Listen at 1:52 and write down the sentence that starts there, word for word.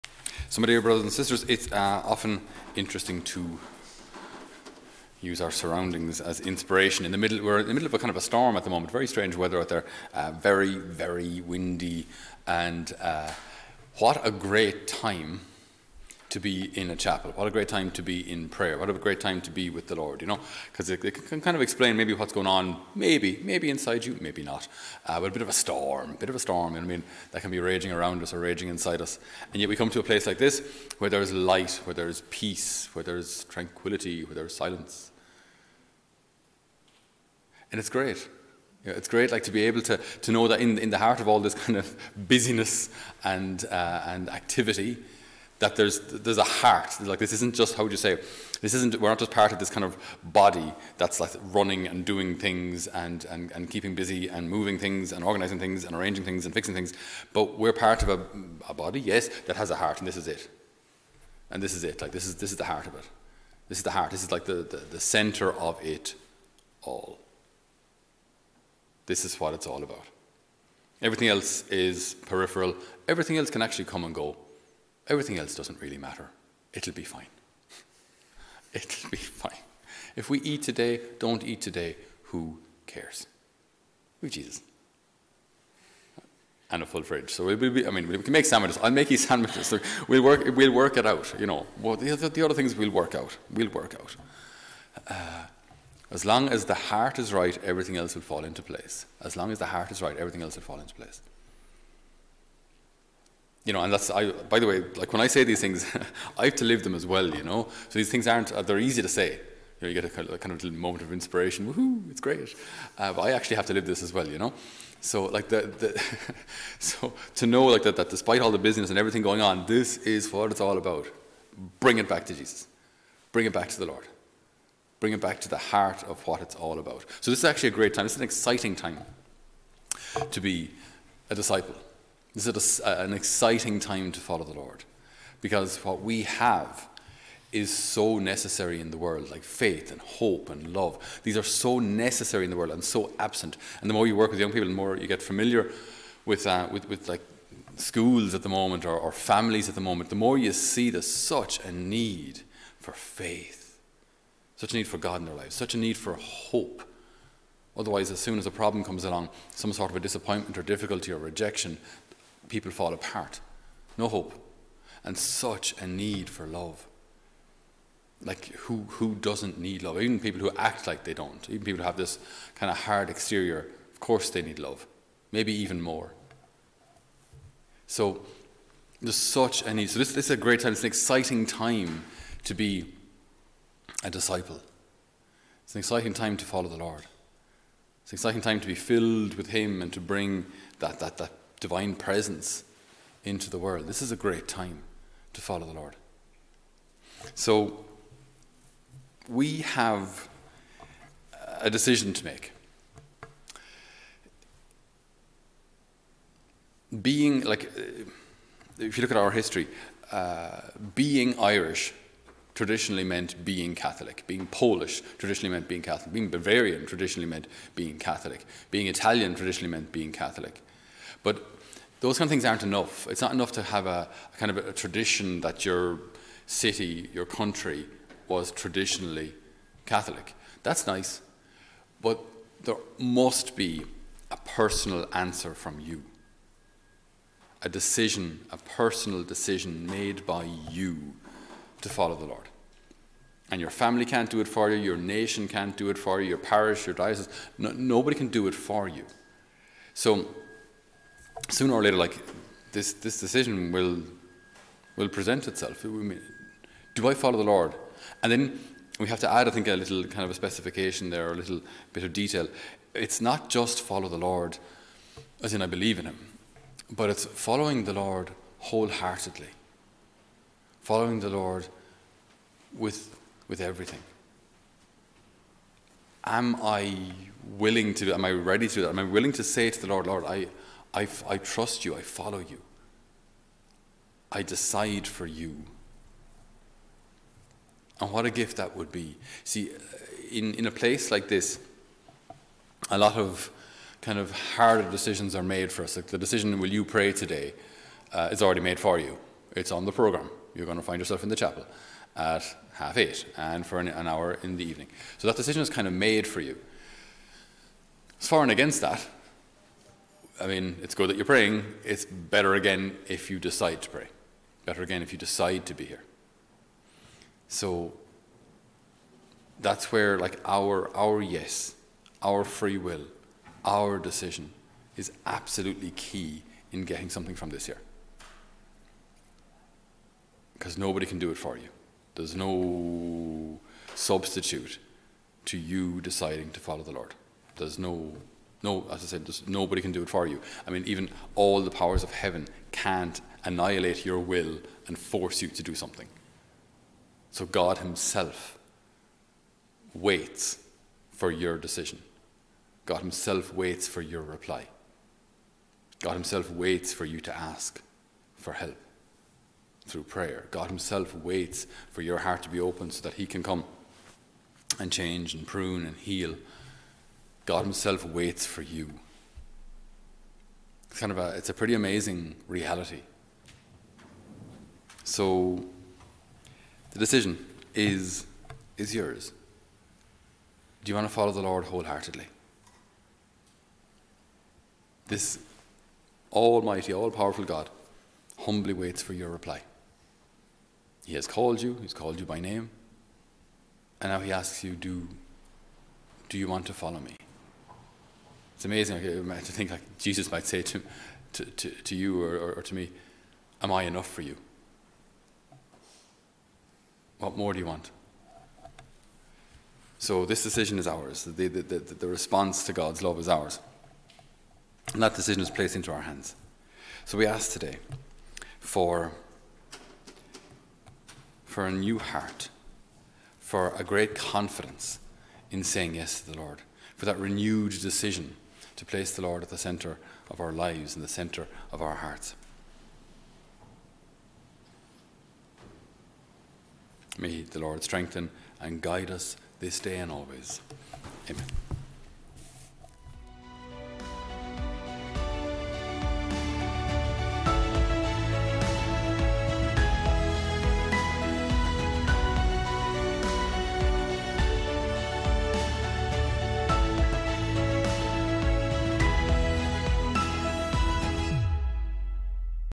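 Uh, but I actually have to live this as well, you know?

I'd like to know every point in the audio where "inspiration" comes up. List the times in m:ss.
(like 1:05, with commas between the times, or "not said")
0:06, 1:51.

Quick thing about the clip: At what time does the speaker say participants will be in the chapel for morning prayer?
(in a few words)
half eight.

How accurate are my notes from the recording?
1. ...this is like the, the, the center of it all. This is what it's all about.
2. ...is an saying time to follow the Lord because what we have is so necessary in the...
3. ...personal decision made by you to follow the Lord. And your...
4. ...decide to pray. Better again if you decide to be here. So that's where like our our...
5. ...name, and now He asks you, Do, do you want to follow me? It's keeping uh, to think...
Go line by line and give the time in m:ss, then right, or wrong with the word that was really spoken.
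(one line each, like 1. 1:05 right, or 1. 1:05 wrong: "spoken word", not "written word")
1. 1:04 right
2. 2:12 wrong: "exciting", not "saying"
3. 3:58 right
4. 5:13 right
5. 6:32 wrong: "amazing", not "keeping".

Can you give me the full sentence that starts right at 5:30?
Because nobody can do it for you.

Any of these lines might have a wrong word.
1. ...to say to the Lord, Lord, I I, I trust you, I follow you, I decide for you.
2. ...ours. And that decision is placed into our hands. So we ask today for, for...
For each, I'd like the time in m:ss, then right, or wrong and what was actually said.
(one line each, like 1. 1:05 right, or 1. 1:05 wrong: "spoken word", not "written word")
1. 4:39 right
2. 6:53 right.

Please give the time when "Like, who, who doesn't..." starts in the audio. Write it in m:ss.
2:48.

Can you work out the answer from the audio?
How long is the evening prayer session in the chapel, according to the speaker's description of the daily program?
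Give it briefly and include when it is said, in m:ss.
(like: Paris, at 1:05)
an hour, at 5:03.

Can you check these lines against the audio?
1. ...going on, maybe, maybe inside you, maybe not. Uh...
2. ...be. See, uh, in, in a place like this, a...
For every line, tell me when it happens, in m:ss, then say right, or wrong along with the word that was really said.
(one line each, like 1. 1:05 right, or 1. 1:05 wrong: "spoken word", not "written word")
1. 0:22 right
2. 4:48 right.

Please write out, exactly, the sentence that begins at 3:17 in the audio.
So we have a decision to make.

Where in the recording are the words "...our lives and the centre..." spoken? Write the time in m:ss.
7:10.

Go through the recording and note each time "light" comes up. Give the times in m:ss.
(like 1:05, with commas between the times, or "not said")
0:31.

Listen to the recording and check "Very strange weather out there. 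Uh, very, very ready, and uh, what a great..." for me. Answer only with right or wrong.
wrong.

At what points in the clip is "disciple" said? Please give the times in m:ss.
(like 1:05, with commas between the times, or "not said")
2:11, 3:04.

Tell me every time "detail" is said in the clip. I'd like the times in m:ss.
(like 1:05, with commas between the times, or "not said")
4:22.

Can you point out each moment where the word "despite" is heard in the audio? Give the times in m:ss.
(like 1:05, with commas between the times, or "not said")
1:58.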